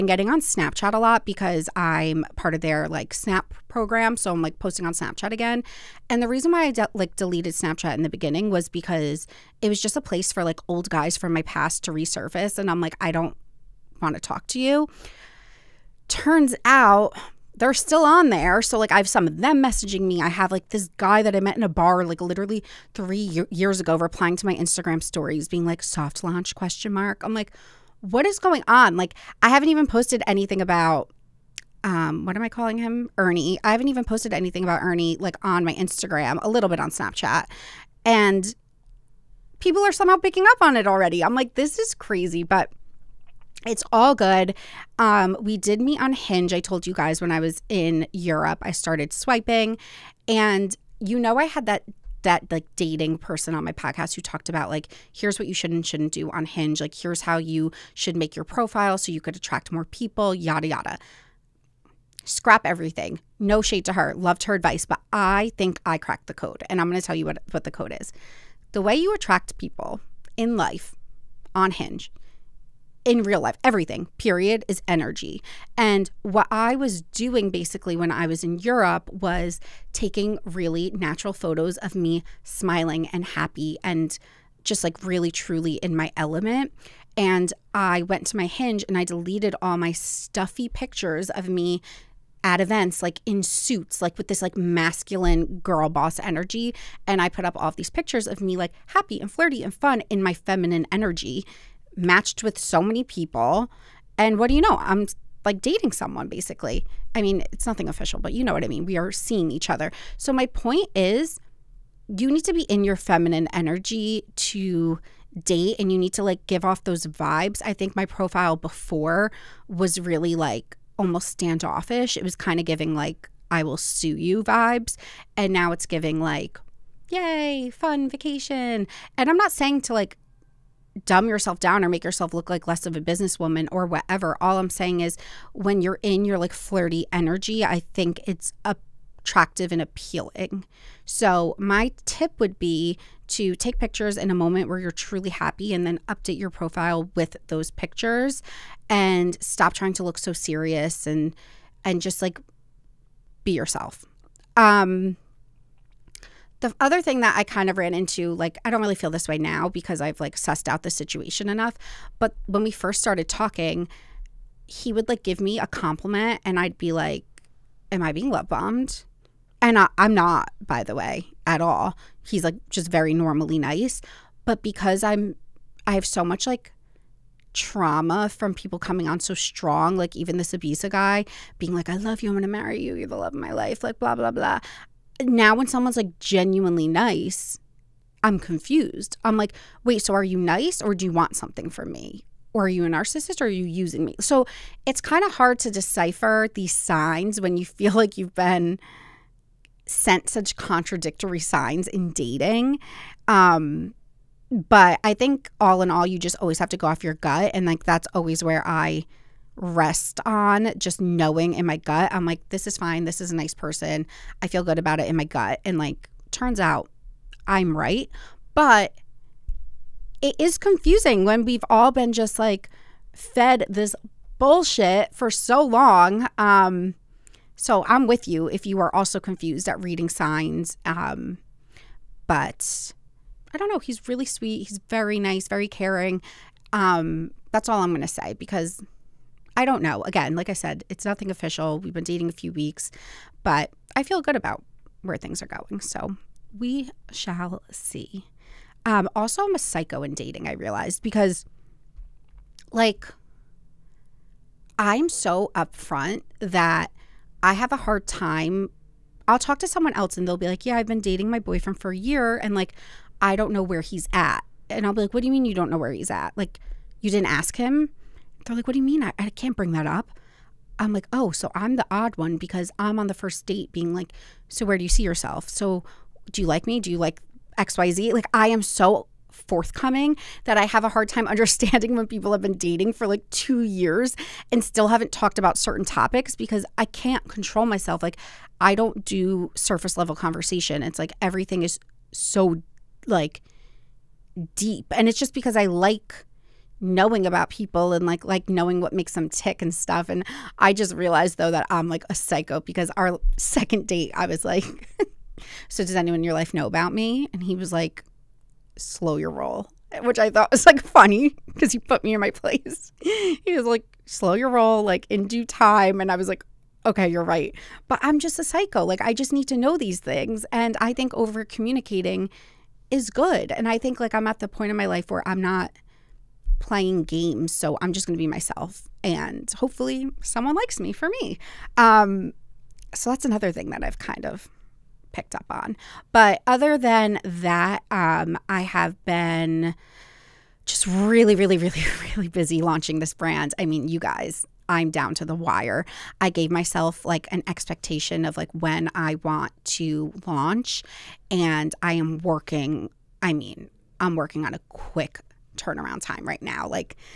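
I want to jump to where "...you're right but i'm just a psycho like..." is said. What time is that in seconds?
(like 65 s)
317 s.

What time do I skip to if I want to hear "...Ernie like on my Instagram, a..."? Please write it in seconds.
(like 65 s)
34 s.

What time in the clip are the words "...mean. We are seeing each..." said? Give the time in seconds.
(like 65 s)
108 s.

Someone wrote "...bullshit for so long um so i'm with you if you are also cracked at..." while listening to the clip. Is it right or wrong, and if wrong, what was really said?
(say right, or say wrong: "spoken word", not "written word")
wrong: "confused", not "cracked".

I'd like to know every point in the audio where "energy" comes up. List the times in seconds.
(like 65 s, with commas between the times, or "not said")
74 s, 96 s, 100 s, 113 s, 137 s.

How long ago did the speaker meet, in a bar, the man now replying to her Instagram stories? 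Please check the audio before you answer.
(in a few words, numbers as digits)
3 years.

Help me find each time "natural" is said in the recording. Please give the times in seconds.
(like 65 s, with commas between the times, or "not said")
80 s.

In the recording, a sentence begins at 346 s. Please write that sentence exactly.
I gave myself like an expectation of like when I want to launch, and I am working.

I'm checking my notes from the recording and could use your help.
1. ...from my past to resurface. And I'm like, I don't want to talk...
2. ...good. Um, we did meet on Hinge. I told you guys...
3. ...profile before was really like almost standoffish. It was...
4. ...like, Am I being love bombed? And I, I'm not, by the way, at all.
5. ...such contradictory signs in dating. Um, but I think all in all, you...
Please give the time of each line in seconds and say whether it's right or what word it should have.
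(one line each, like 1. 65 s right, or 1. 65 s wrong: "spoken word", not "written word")
1. 11 s right
2. 44 s right
3. 118 s right
4. 166 s right
5. 200 s right.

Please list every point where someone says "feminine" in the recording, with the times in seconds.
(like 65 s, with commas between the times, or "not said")
100 s, 112 s.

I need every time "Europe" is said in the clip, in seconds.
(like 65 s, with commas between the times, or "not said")
48 s, 78 s.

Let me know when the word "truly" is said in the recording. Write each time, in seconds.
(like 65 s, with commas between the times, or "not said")
85 s, 144 s.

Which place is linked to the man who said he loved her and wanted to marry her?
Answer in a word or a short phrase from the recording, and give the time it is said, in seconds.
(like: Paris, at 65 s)
Ibiza, at 180 s.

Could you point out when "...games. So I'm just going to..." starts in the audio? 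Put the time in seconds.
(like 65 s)
327 s.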